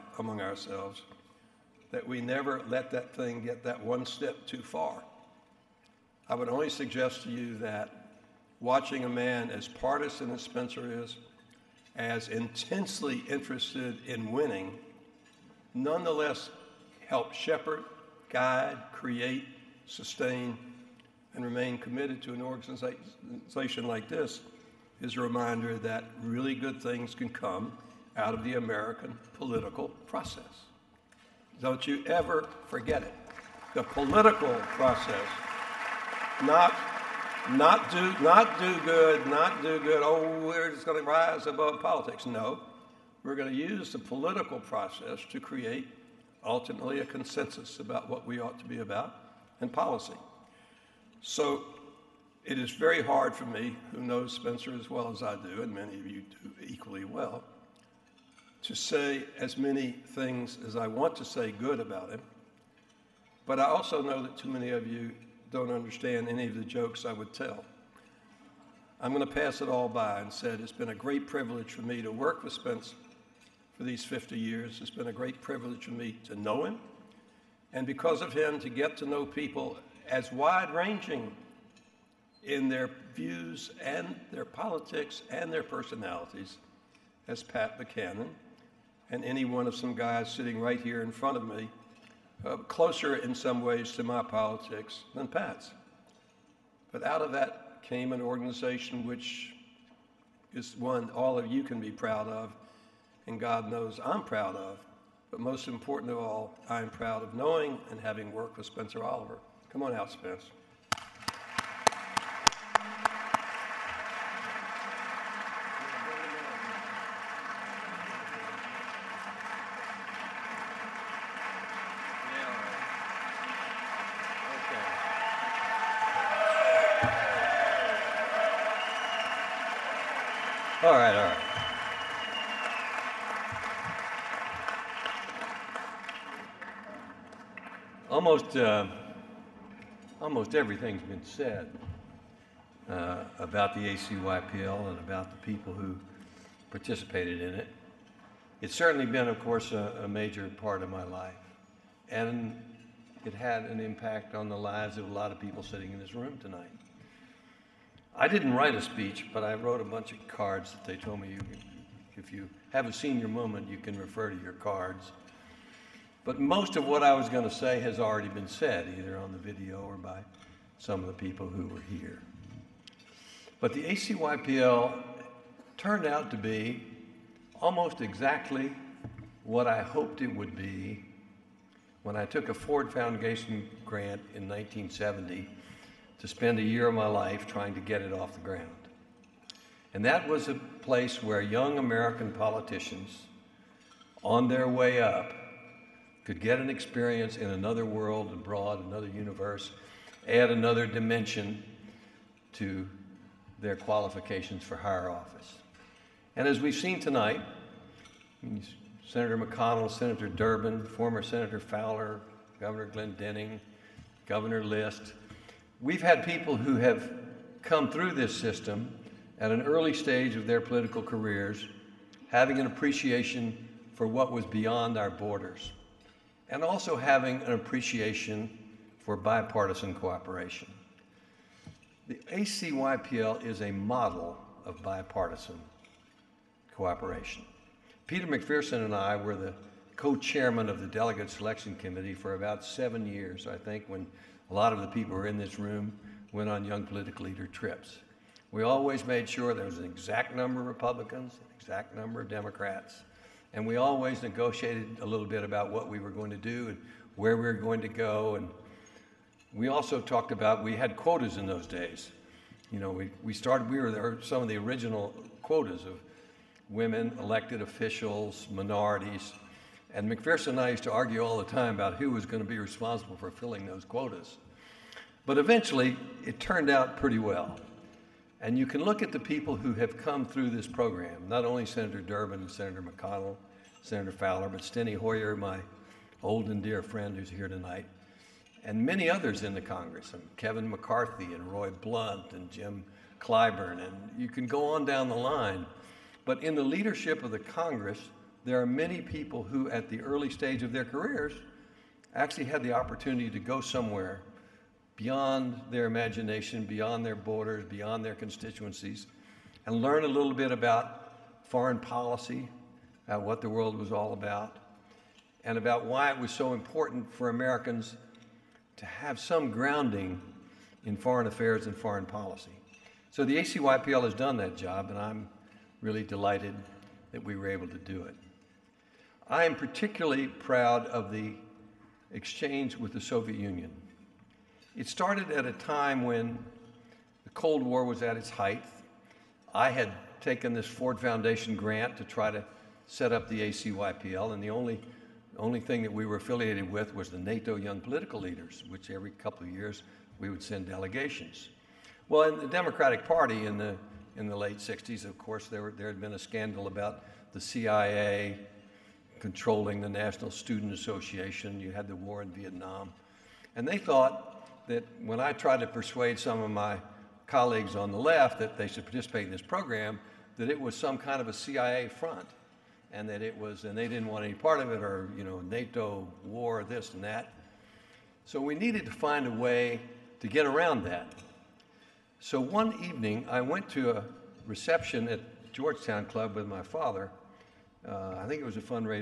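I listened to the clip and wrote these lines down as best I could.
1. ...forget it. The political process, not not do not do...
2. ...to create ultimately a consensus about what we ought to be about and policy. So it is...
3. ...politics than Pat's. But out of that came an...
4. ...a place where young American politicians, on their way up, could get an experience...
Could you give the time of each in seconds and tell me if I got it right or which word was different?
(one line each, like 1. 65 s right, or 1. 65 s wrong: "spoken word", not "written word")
1. 32 s right
2. 45 s right
3. 94 s right
4. 190 s right.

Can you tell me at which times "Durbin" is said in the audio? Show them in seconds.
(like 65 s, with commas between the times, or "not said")
210 s, 282 s.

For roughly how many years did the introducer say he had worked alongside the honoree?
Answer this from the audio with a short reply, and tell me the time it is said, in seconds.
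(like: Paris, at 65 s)
50 years, at 73 s.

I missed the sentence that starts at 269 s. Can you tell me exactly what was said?
And McPherson and I used to argue all the time about who was going to be responsible for filling those quotas.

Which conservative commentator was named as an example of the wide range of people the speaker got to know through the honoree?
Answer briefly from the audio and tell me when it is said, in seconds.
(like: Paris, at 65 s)
Pat Buchanan, at 87 s.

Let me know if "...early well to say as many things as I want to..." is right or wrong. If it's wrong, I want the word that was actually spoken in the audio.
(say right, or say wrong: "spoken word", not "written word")
wrong: "equally", not "early".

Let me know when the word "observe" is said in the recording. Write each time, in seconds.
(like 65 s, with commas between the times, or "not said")
not said.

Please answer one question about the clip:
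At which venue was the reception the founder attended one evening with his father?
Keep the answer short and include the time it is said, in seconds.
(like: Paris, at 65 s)
Georgetown Club, at 385 s.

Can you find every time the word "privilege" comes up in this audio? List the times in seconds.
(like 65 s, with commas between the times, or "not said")
71 s, 75 s.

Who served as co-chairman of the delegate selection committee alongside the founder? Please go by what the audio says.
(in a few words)
Peter McPherson.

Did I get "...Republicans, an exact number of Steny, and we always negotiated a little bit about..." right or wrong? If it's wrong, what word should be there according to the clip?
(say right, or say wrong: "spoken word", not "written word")
wrong: "Democrats", not "Steny".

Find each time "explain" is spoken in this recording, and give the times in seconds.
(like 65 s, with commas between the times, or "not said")
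not said.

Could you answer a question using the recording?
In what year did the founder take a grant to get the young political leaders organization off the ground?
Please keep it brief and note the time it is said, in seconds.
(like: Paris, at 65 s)
1970, at 184 s.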